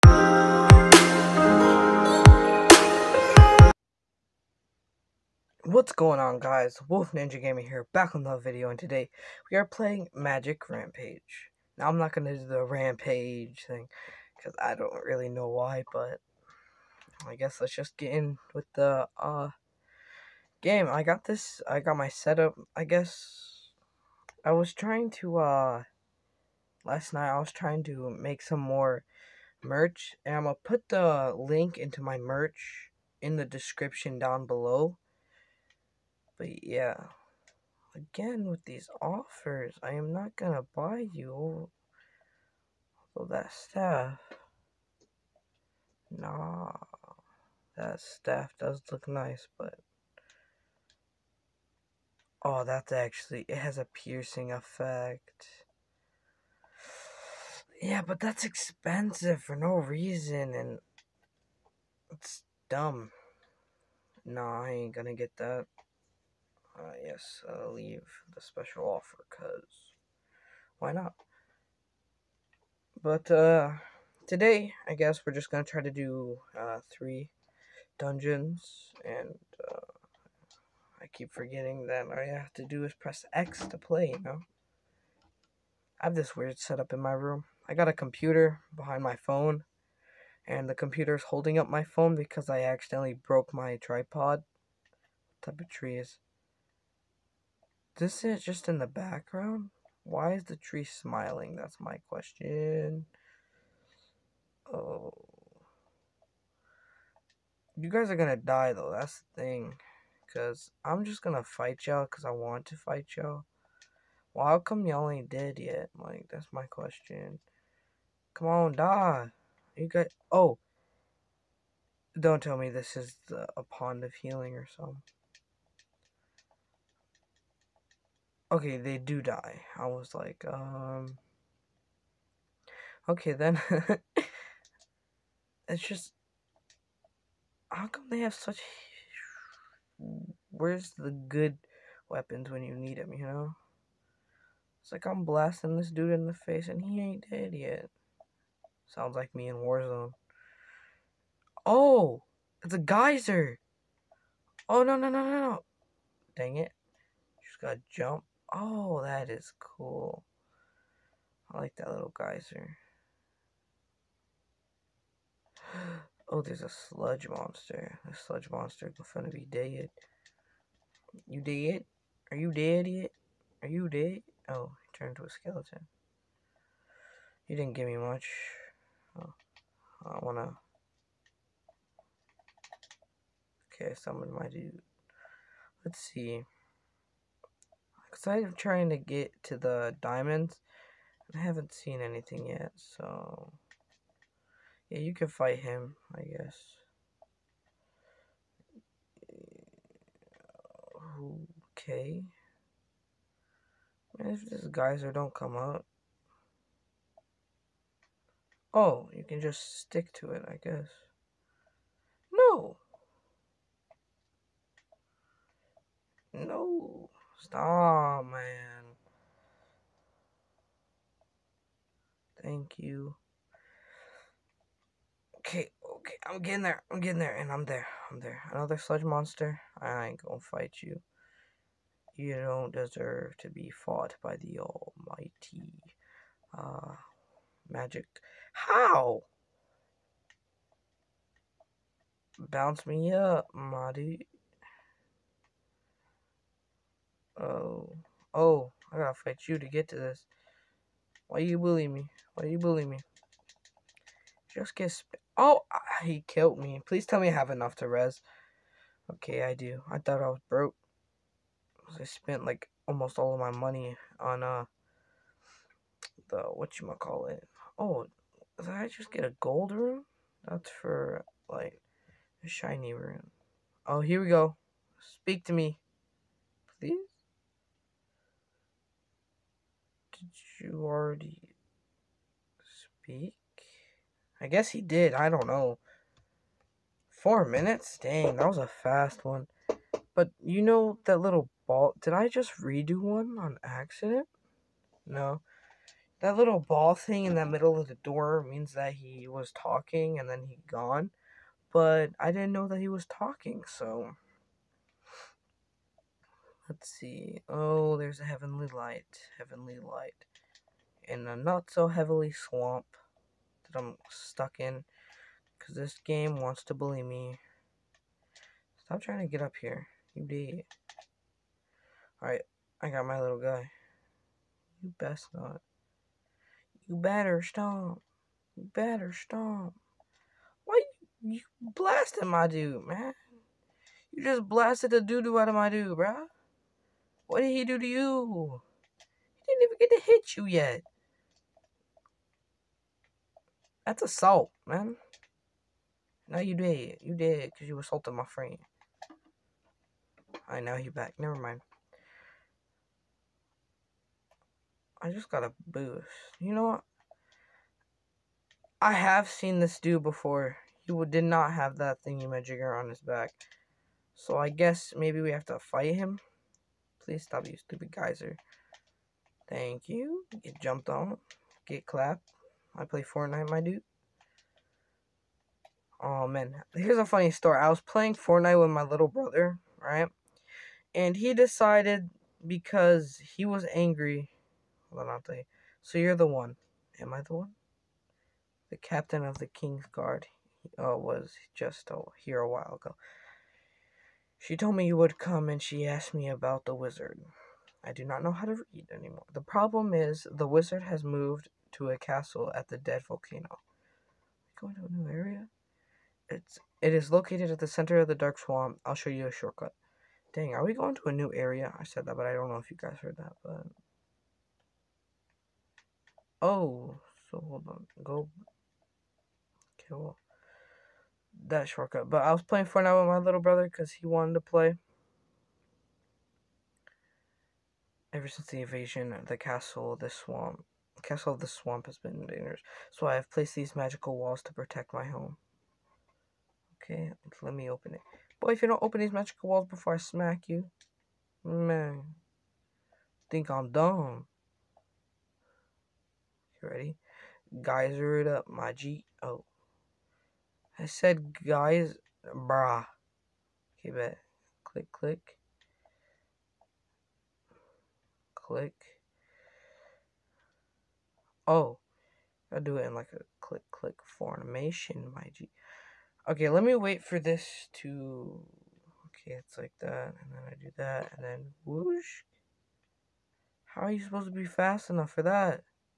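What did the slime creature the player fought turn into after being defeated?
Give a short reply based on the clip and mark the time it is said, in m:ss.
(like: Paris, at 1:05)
A skeleton, at 2:55.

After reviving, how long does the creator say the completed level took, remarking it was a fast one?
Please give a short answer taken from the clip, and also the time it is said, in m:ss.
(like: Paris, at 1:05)
4 minutes, at 4:47.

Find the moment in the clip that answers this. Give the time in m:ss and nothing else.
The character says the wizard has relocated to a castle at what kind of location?
6:42.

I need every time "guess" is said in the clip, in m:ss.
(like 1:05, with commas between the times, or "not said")
0:17, 0:22, 1:14, 3:16, 3:30, 4:44, 6:04.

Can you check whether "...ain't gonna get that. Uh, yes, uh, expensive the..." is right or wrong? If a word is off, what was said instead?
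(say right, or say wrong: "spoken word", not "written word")
wrong: "leave", not "expensive".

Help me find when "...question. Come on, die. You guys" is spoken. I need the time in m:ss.
1:56.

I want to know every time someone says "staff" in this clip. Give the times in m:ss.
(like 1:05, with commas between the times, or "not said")
0:43, 0:47.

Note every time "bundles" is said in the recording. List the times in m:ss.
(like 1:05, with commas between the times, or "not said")
not said.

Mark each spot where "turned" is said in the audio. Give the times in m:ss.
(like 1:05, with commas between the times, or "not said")
2:54.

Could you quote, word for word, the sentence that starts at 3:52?
You don't deserve to be fought by the almighty uh, magic.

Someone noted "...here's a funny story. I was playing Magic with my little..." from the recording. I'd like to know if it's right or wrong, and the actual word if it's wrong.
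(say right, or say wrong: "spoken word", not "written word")
wrong: "Fortnite", not "Magic".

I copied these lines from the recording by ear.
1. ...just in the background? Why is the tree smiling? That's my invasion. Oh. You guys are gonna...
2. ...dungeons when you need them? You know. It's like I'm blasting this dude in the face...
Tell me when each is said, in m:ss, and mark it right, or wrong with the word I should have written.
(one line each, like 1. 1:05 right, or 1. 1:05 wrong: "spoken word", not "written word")
1. 1:38 wrong: "question", not "invasion"
2. 2:22 wrong: "weapons", not "dungeons".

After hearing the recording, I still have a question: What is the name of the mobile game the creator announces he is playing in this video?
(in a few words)
Magic Rampage.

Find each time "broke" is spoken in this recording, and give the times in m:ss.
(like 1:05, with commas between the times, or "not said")
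1:33, 4:20.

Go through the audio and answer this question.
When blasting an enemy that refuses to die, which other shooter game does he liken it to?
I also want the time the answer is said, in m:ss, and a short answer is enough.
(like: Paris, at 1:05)
Warzone, at 2:29.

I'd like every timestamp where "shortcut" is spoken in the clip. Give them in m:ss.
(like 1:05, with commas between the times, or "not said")
6:49, 7:01.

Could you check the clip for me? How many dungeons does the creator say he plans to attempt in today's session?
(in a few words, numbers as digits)
3.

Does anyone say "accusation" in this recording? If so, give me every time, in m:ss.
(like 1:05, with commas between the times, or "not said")
not said.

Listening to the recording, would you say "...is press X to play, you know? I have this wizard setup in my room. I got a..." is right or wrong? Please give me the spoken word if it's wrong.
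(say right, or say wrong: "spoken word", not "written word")
wrong: "weird", not "wizard".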